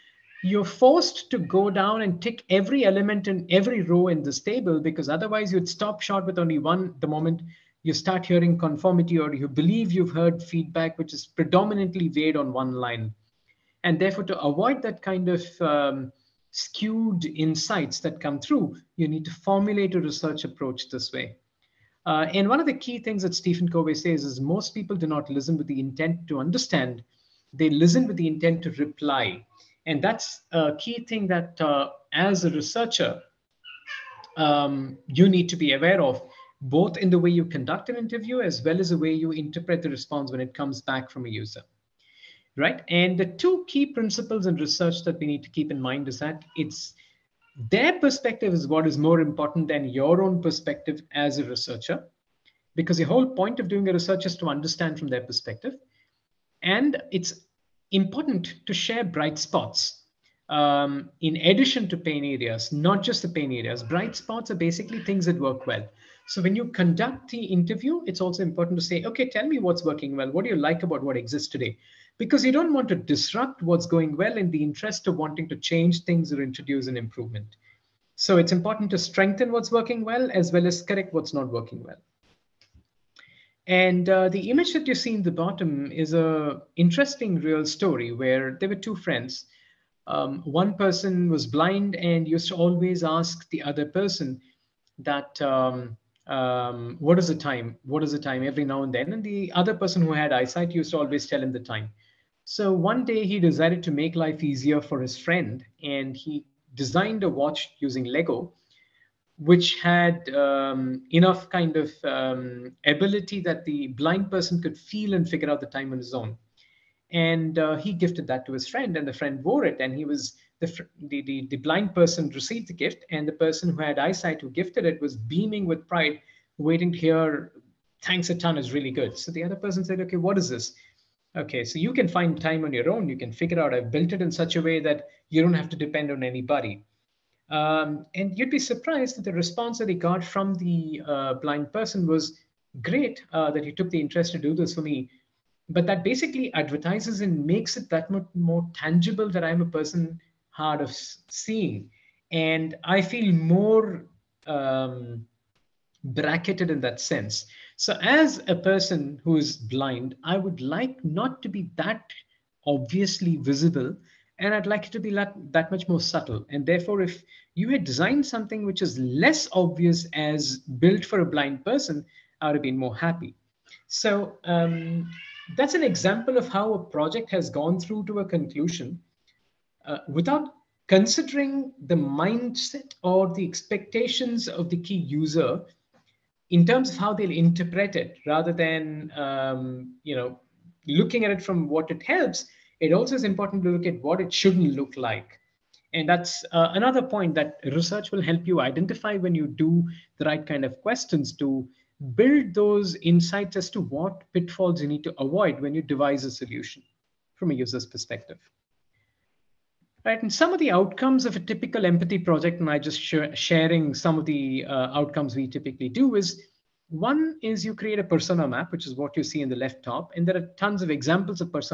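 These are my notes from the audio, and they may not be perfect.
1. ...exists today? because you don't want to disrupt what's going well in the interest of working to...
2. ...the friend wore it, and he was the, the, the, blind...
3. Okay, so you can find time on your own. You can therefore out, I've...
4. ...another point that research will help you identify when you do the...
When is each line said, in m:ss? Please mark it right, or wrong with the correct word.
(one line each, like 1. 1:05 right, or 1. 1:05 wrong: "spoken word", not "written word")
1. 1:11 wrong: "wanting", not "working"
2. 1:59 right
3. 2:11 wrong: "figure", not "therefore"
4. 3:16 right.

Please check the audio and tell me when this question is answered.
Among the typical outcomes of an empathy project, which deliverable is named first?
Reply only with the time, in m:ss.
3:38.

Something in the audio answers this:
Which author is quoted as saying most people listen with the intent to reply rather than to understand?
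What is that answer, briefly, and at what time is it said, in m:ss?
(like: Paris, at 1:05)
Stephen Covey, at 0:23.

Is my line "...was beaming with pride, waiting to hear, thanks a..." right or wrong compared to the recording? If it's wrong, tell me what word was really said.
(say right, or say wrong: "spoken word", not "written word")
right.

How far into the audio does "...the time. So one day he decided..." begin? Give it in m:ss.
1:41.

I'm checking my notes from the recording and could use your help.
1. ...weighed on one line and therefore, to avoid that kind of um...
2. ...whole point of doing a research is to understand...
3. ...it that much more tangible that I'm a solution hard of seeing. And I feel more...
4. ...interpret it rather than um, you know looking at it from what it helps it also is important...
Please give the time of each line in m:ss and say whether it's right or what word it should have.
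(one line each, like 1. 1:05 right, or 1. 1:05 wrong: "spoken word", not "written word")
1. 0:12 right
2. 0:53 right
3. 2:27 wrong: "person", not "solution"
4. 3:07 right.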